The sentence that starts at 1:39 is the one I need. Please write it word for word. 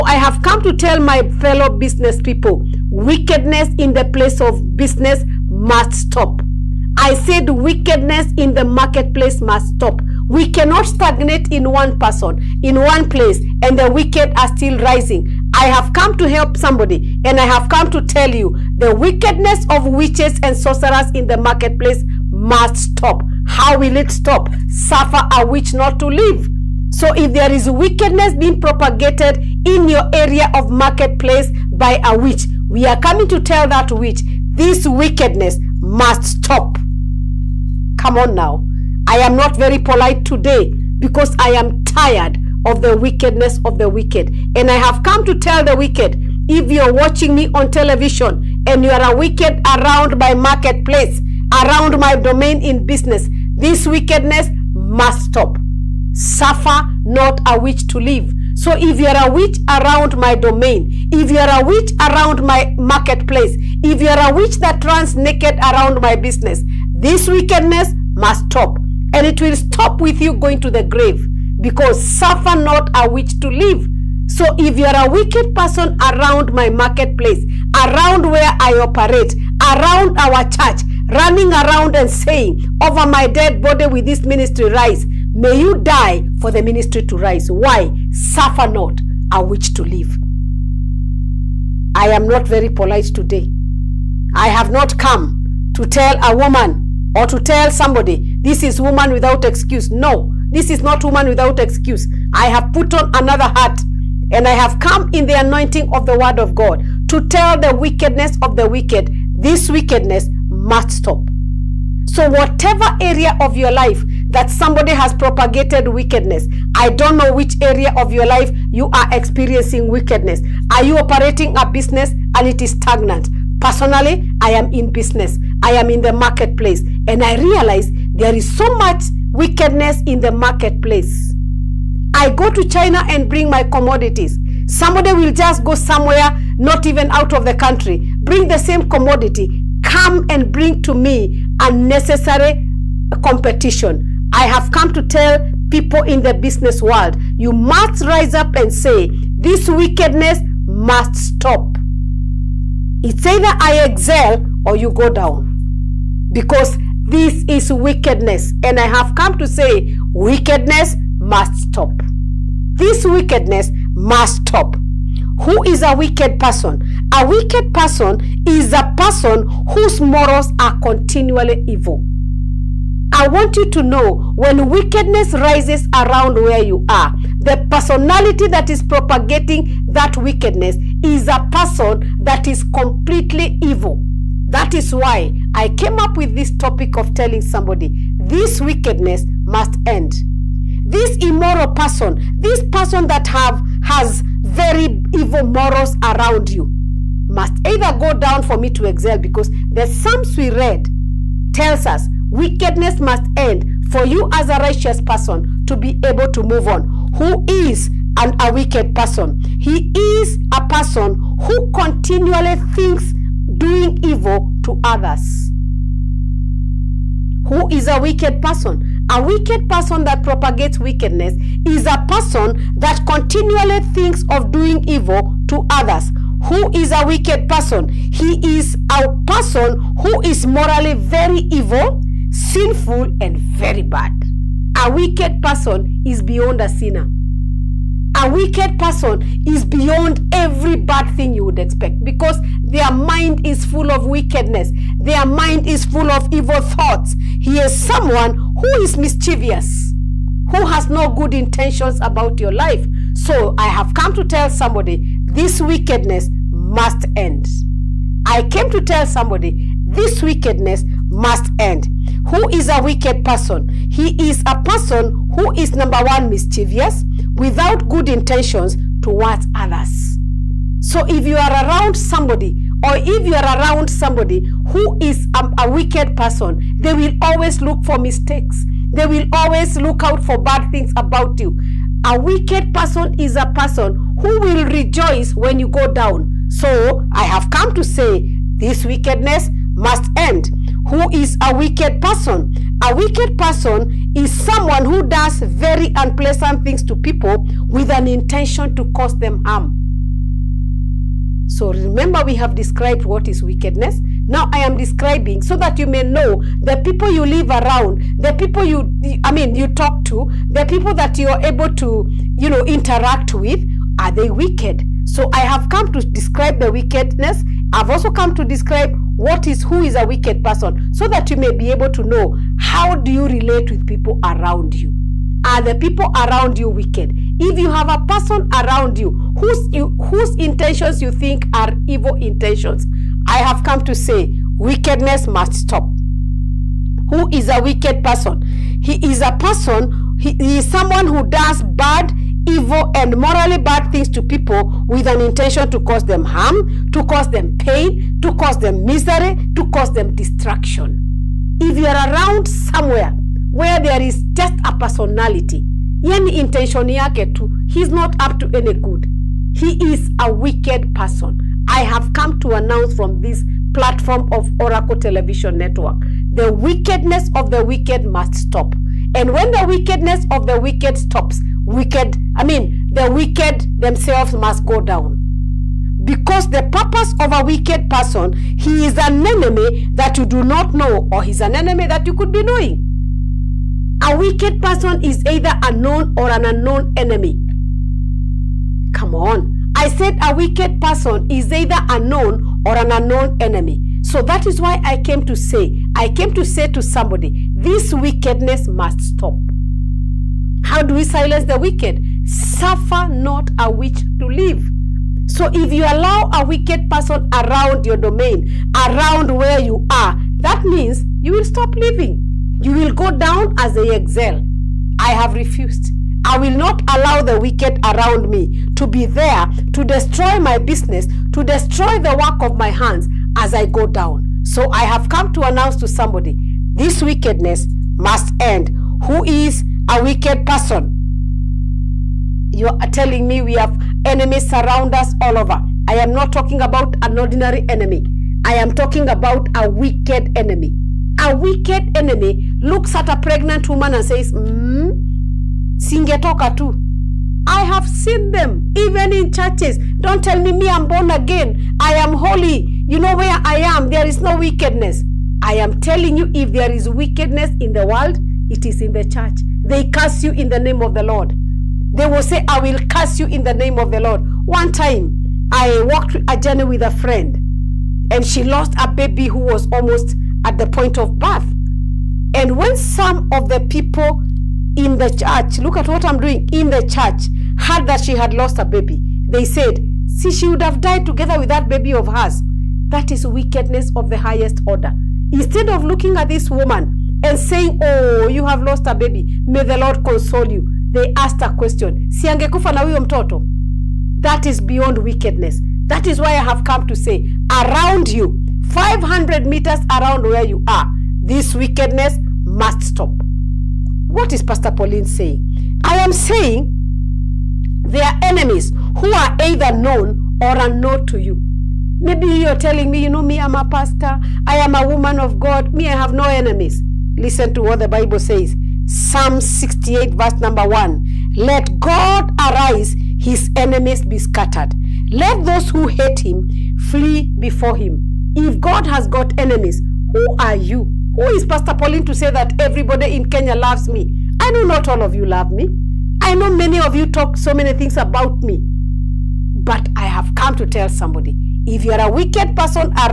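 No, this is not woman without excuse.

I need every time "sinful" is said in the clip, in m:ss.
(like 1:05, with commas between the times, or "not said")
3:52.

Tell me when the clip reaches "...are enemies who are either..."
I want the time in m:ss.
8:28.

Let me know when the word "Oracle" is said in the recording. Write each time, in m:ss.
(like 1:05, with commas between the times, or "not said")
6:04.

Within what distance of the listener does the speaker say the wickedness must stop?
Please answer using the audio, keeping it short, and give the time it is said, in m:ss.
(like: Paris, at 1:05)
500 meters, at 8:18.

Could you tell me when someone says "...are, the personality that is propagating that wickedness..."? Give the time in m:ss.
2:56.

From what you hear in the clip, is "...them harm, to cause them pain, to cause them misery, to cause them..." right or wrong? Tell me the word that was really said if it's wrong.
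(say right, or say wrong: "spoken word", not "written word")
right.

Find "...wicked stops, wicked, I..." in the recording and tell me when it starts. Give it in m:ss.
6:10.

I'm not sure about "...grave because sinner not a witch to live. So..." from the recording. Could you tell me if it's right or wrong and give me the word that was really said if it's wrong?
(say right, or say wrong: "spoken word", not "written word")
wrong: "suffer", not "sinner".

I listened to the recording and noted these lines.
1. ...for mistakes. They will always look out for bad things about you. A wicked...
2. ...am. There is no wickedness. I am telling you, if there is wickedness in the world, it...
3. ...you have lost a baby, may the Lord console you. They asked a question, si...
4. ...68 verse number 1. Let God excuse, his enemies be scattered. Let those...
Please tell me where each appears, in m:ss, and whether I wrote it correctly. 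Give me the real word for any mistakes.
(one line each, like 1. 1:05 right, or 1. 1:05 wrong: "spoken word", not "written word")
1. 4:37 right
2. 7:33 right
3. 8:08 right
4. 8:39 wrong: "arise", not "excuse".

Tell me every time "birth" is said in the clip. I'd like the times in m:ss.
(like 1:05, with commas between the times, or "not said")
7:51.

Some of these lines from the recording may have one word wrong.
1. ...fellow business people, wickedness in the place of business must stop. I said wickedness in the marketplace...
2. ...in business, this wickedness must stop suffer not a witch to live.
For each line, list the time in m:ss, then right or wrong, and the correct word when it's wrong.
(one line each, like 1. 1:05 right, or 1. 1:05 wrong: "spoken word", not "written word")
1. 0:01 right
2. 0:52 right.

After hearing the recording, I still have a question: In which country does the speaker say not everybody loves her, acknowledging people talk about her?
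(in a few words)
Kenya.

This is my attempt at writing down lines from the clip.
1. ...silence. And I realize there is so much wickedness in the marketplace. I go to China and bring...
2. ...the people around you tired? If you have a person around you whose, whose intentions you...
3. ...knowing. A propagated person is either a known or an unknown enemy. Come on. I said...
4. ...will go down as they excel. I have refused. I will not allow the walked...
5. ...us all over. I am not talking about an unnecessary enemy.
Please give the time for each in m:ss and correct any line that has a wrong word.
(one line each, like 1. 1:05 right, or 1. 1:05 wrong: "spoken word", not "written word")
1. 2:06 wrong: "marketplace", not "silence"
2. 5:25 wrong: "wicked", not "tired"
3. 6:22 wrong: "wicked", not "propagated"
4. 6:52 wrong: "wicked", not "walked"
5. 7:14 wrong: "ordinary", not "unnecessary".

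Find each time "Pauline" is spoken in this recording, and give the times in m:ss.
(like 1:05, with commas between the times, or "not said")
8:24, 8:51.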